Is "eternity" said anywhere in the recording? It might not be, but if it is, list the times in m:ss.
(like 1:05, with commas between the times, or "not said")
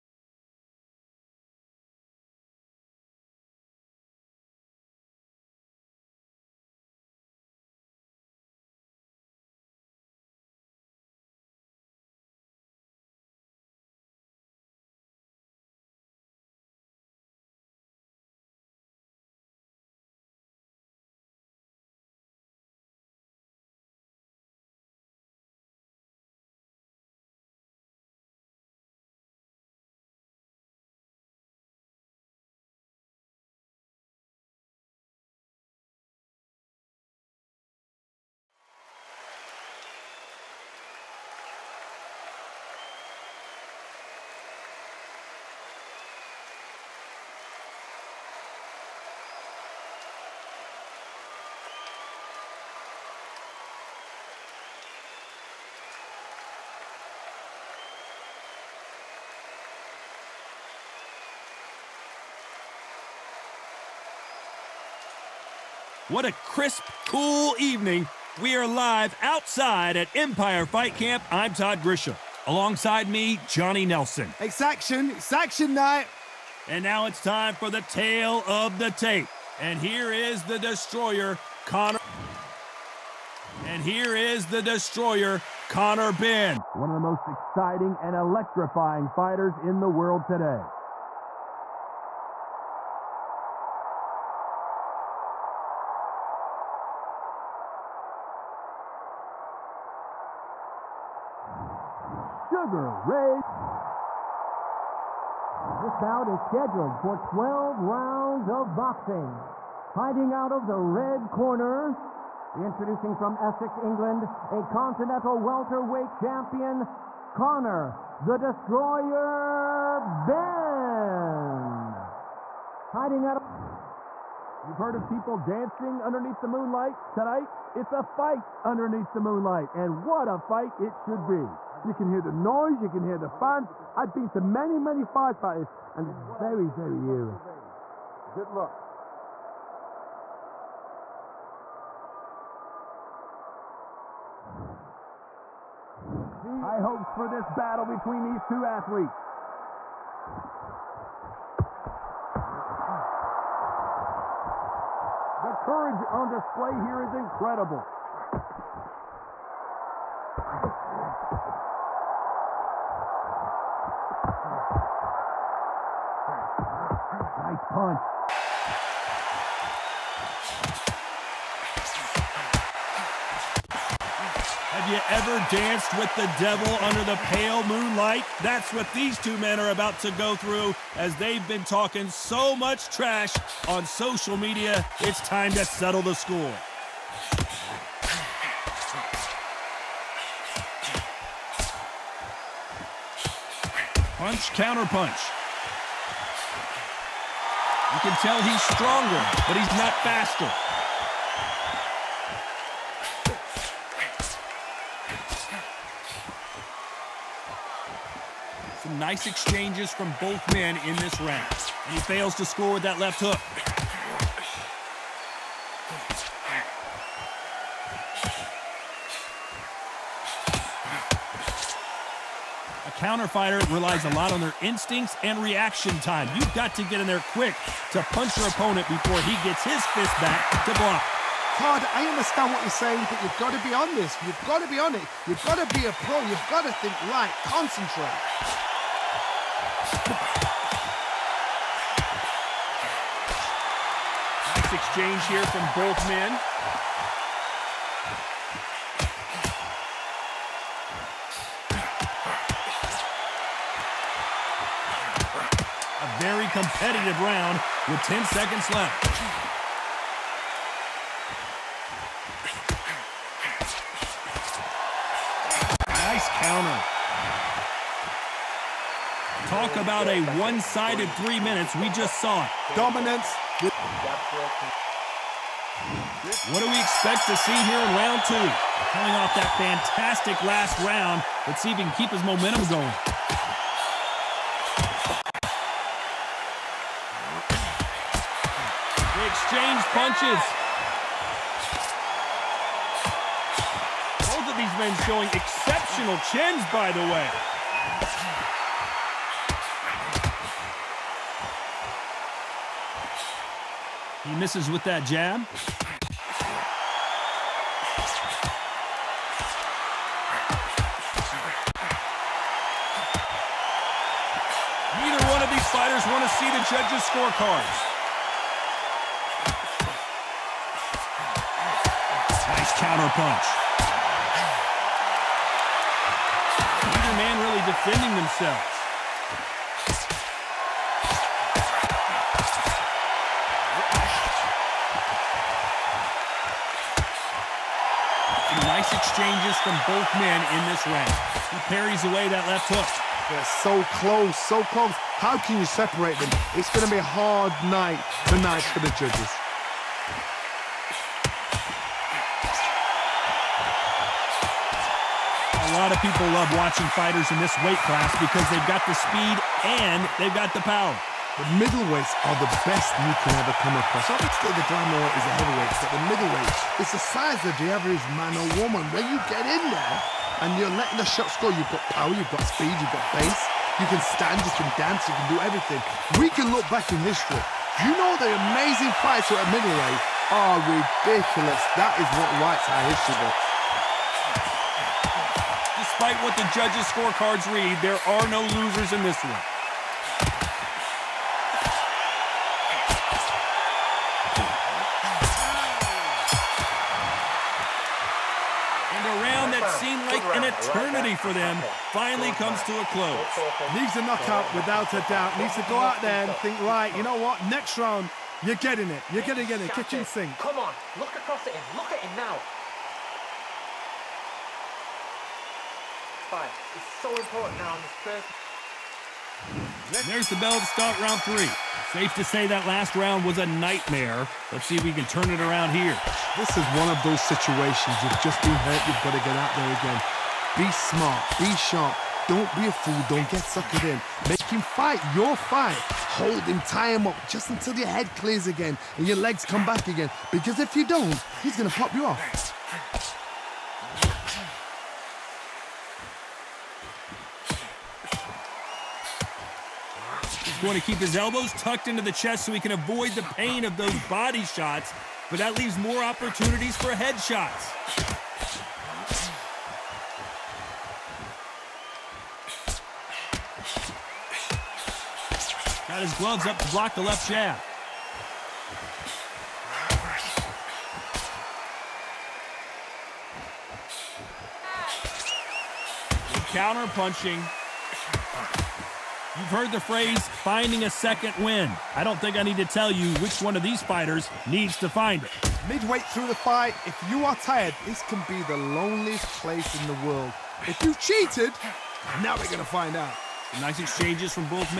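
6:40.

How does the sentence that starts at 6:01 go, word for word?
The middleweights are the best you can ever come across.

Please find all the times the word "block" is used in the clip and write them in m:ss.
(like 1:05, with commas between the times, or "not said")
3:50, 7:46.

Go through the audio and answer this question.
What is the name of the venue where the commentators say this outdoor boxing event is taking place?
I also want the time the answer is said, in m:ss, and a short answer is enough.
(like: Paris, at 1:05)
Empire Fight Camp, at 1:10.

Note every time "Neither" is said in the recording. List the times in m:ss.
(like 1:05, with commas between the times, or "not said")
5:14, 5:26.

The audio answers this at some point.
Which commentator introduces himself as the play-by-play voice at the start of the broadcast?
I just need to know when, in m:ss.
1:11.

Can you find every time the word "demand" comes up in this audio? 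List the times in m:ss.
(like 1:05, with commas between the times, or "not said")
not said.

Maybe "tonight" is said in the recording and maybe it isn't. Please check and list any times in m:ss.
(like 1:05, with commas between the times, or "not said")
2:07, 5:48.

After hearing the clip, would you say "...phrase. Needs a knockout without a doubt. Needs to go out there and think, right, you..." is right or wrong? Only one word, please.
wrong.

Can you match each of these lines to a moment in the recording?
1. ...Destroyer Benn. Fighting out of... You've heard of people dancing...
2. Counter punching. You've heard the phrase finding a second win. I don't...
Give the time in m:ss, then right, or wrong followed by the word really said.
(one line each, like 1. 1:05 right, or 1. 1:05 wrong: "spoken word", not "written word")
1. 1:58 right
2. 7:56 right.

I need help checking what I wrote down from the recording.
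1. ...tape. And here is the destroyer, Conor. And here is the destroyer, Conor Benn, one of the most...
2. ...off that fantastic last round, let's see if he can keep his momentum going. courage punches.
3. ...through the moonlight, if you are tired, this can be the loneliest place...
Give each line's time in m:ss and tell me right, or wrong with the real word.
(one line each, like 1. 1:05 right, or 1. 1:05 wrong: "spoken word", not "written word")
1. 1:18 right
2. 4:39 wrong: "exchange", not "courage"
3. 8:05 wrong: "fight", not "moonlight".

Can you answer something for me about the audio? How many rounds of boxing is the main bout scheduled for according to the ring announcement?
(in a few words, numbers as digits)
12.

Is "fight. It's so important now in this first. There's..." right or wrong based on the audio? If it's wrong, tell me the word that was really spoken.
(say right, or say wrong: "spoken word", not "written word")
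right.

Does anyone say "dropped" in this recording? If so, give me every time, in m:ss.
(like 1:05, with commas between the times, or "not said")
not said.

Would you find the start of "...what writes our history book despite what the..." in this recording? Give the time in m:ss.
6:22.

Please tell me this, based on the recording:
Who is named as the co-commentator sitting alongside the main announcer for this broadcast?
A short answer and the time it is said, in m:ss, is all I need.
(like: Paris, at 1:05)
Johnny Nelson, at 1:13.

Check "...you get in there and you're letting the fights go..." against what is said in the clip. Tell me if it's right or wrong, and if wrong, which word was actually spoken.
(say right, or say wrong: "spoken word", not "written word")
wrong: "shots", not "fights".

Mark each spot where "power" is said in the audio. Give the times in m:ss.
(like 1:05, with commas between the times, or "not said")
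6:00, 6:11.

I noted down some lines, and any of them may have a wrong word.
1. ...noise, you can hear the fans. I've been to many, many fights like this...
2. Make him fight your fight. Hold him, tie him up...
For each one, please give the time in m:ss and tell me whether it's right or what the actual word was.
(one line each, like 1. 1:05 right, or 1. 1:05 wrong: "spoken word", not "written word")
1. 2:12 right
2. 7:14 right.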